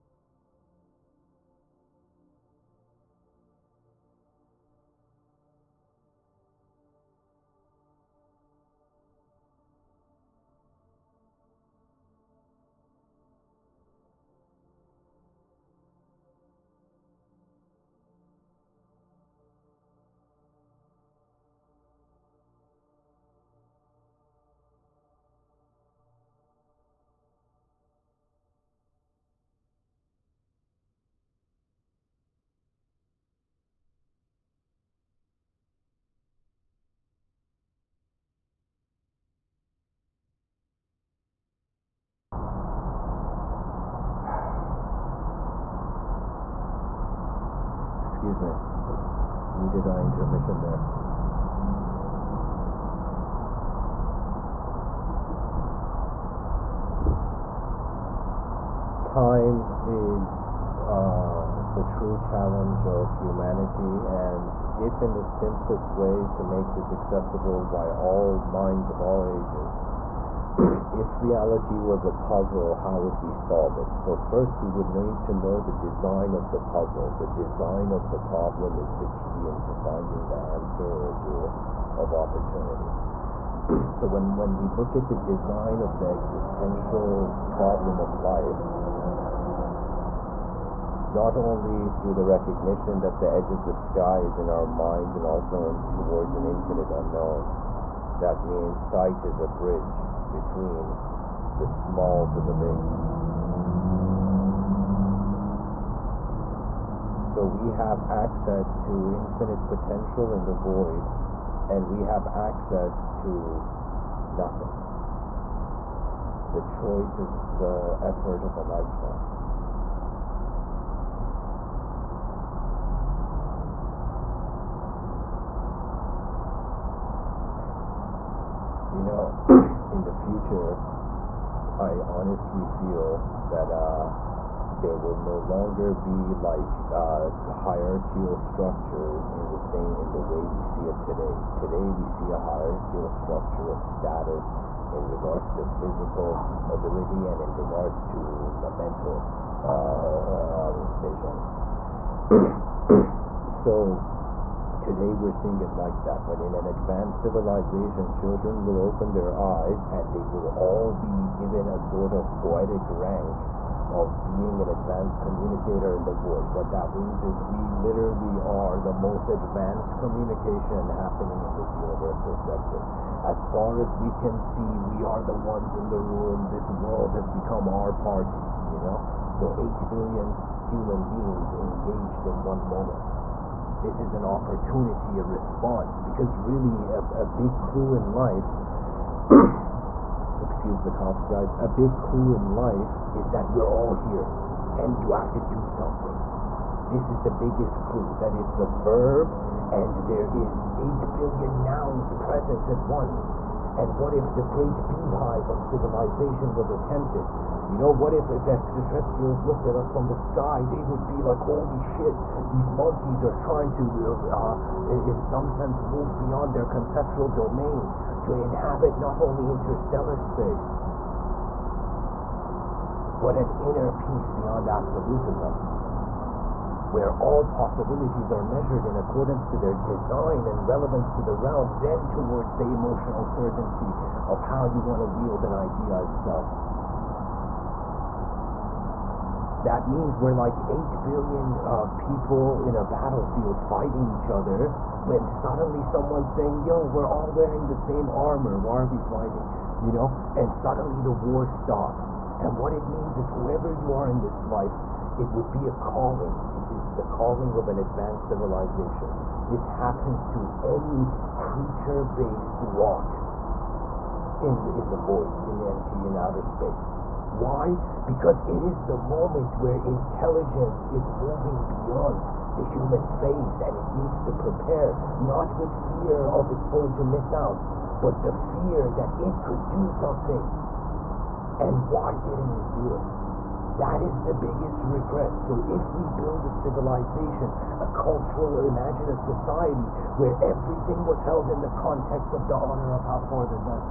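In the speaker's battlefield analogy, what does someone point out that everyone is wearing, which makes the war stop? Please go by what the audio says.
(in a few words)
The same armor.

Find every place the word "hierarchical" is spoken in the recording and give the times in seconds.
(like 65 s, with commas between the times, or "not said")
137 s, 142 s.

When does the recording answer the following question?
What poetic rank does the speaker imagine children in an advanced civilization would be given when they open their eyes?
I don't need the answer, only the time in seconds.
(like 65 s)
164 s.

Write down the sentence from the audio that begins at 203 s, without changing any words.
And what if the great beehive of civilization was attempted?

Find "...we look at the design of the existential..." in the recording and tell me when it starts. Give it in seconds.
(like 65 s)
84 s.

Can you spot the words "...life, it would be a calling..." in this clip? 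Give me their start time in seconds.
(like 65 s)
254 s.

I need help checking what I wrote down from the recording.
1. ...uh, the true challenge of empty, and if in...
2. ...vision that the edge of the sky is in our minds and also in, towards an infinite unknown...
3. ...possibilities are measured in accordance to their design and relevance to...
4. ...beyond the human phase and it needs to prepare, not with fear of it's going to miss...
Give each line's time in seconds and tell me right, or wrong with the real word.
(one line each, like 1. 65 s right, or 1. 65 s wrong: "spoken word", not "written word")
1. 60 s wrong: "humanity", not "empty"
2. 92 s wrong: "recognition", not "vision"
3. 227 s right
4. 271 s right.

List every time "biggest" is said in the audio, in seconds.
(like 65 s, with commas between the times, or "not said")
197 s, 284 s.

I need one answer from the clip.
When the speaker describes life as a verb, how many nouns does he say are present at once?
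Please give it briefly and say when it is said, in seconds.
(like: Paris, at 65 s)
8 billion, at 200 s.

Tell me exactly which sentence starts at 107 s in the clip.
So we have access to infinite potential in the void, and we have access to nothing.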